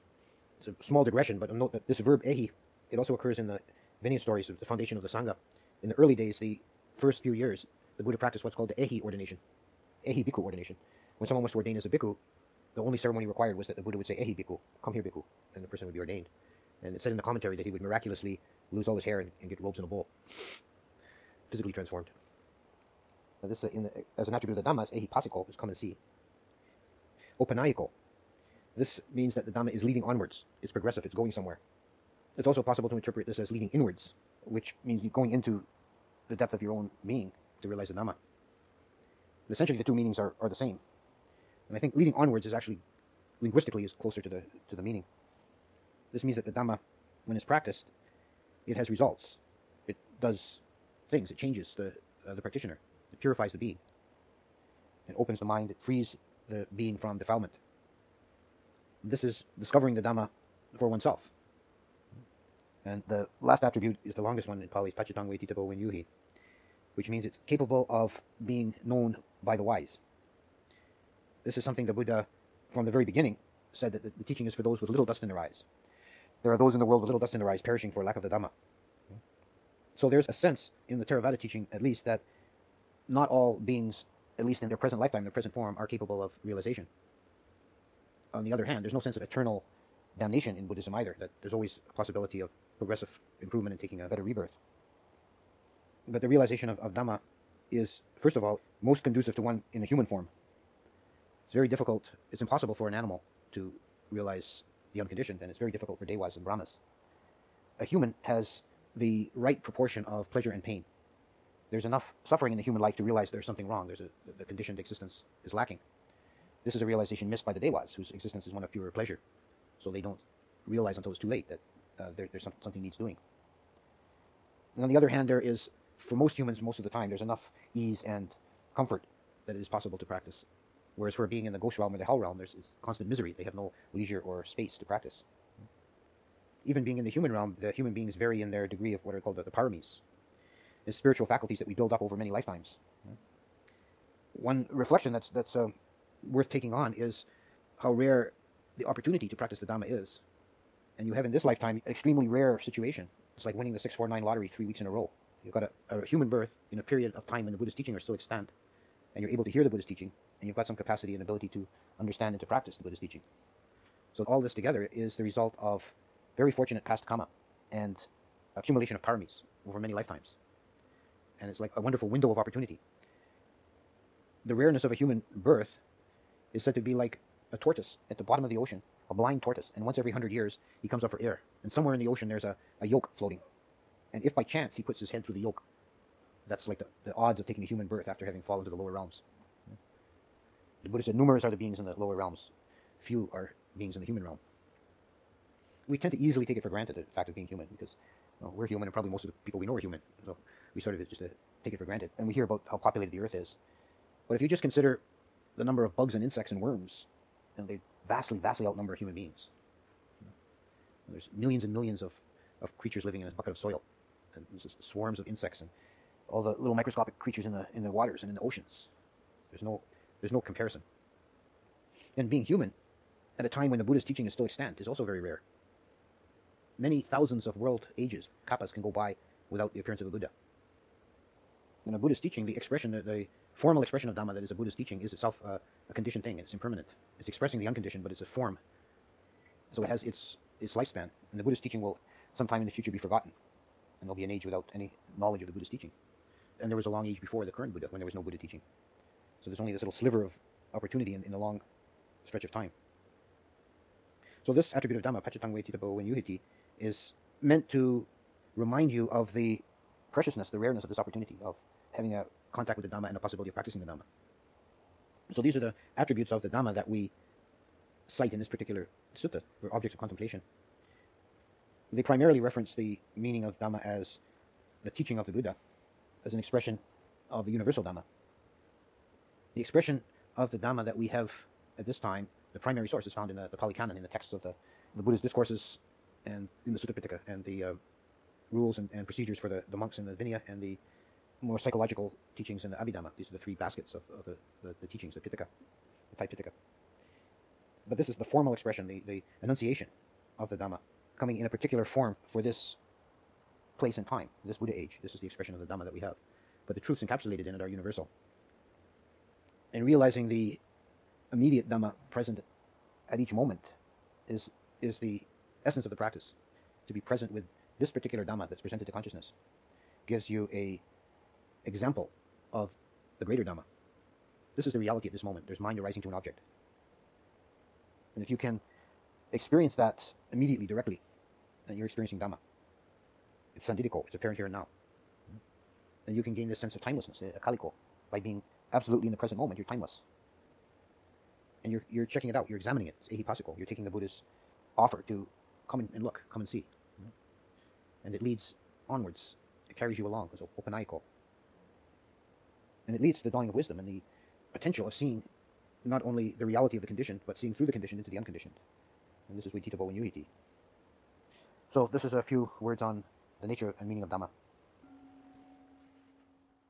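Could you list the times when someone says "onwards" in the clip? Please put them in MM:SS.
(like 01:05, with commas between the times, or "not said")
00:30, 00:42, 05:48.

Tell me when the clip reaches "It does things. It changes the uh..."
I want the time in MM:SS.
00:49.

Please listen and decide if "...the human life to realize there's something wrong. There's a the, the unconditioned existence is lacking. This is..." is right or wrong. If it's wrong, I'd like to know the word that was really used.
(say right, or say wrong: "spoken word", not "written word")
wrong: "conditioned", not "unconditioned".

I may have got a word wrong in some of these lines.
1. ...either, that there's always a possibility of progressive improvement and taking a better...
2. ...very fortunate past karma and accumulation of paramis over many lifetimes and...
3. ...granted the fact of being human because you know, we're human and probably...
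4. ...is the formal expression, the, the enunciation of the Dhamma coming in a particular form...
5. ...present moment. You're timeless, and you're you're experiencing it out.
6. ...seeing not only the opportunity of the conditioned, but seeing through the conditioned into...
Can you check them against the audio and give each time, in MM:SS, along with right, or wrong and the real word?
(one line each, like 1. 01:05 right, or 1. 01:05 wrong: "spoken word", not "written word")
1. 01:30 right
2. 02:46 right
3. 03:16 right
4. 04:58 right
5. 05:39 wrong: "checking", not "experiencing"
6. 05:54 wrong: "reality", not "opportunity".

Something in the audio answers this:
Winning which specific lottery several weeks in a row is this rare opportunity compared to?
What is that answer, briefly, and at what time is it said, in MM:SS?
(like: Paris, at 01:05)
649 lottery, at 02:33.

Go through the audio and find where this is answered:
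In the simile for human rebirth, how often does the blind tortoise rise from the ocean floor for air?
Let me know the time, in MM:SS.
02:59.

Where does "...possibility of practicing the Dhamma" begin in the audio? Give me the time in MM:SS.
04:23.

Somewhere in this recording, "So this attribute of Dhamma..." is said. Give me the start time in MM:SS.
04:14.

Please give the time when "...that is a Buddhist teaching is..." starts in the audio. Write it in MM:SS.
03:54.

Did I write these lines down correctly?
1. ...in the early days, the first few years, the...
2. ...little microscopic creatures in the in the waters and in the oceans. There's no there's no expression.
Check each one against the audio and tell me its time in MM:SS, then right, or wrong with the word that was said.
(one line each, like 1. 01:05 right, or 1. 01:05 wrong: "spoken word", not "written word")
1. 00:05 right
2. 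03:36 wrong: "comparison", not "expression".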